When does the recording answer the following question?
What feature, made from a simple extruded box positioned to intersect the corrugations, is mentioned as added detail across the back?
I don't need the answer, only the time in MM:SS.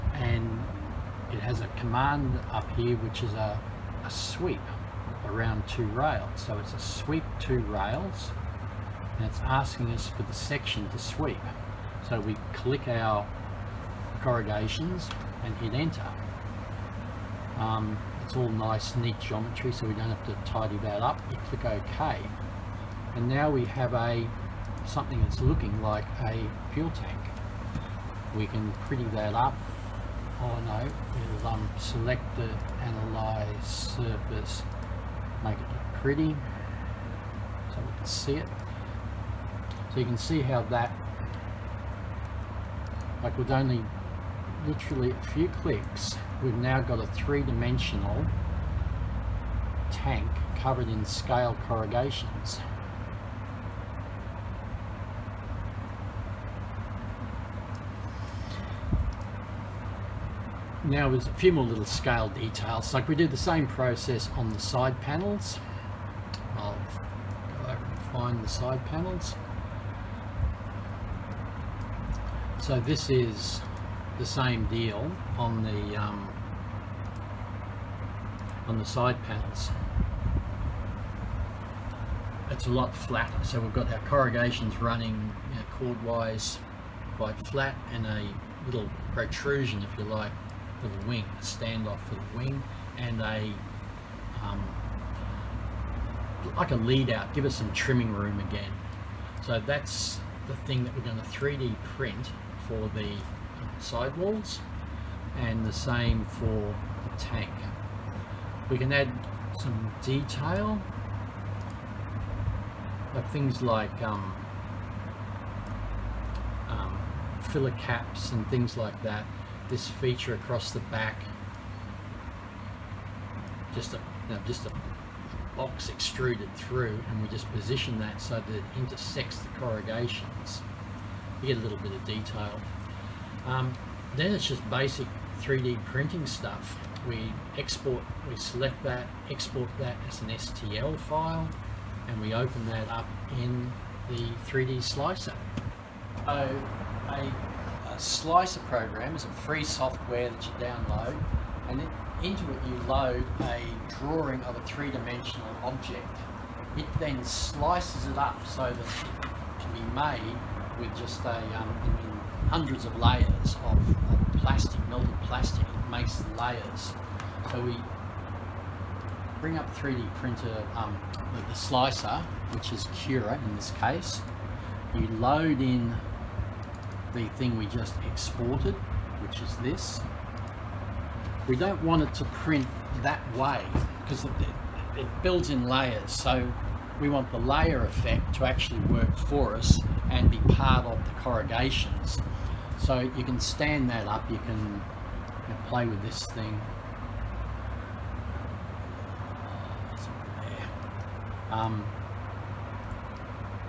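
01:57.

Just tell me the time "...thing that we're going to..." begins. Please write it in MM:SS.
01:40.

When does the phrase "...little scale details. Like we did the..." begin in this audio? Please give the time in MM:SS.
01:01.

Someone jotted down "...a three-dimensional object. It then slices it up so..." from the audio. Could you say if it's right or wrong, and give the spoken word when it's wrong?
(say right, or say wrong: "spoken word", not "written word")
right.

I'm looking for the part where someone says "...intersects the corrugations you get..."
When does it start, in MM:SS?
02:08.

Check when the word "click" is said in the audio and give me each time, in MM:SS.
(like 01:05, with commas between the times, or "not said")
00:12, 00:21, 00:45.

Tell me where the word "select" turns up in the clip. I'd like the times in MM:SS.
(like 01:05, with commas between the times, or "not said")
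00:31, 02:18.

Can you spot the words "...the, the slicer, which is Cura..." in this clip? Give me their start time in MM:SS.
02:51.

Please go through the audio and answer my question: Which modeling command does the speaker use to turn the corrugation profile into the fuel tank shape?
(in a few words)
Sweep two rails.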